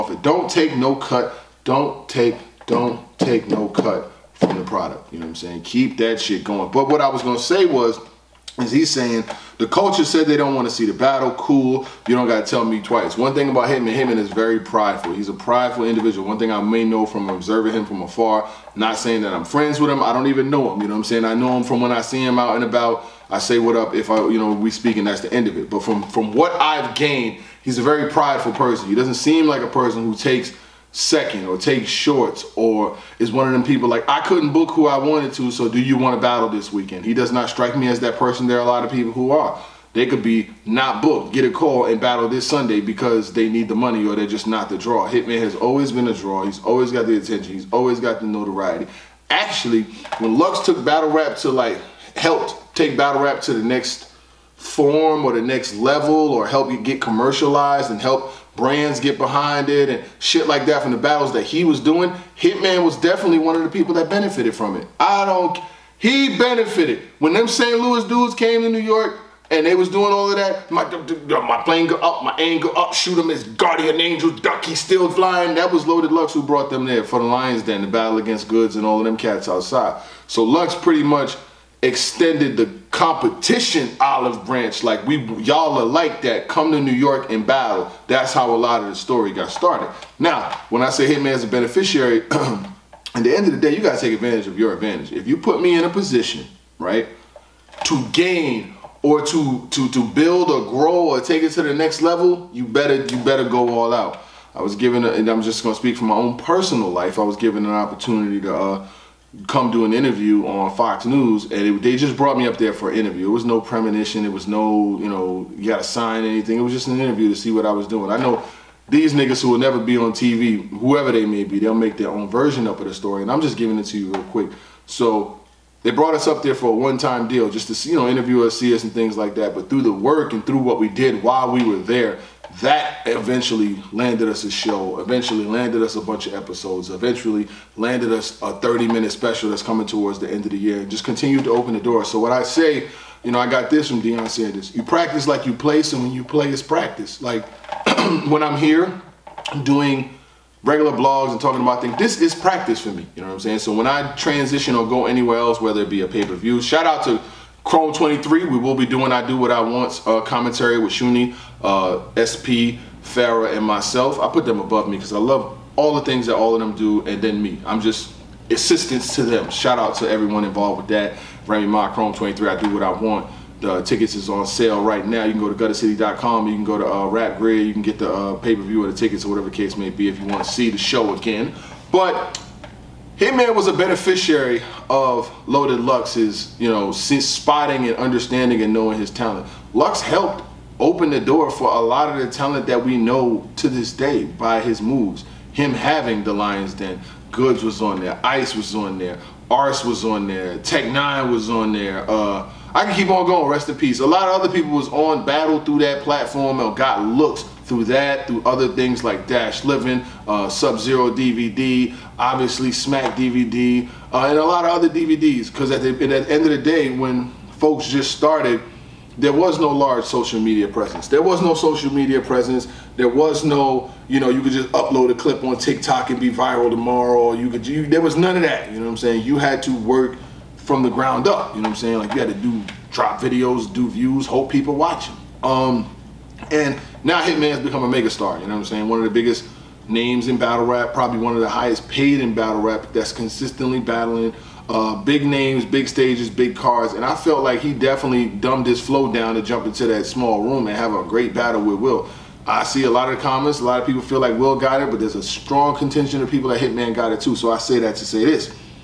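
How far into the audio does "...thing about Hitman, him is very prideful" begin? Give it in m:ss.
0:13.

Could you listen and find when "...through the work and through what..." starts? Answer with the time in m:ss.
2:09.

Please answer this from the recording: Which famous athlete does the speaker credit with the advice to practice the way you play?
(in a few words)
Deion Sanders.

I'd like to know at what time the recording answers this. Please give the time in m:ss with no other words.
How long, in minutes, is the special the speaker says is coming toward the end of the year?
2:18.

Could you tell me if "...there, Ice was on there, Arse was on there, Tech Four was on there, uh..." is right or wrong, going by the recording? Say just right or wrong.
wrong.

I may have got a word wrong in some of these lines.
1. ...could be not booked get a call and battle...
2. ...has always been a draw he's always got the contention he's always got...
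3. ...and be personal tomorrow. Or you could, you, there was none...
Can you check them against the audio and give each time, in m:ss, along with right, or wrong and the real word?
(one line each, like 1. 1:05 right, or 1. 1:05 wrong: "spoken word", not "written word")
1. 0:40 right
2. 0:45 wrong: "attention", not "contention"
3. 3:46 wrong: "viral", not "personal".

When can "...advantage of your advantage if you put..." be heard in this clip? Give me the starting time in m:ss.
1:34.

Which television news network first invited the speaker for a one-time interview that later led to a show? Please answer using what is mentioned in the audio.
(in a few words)
Fox News.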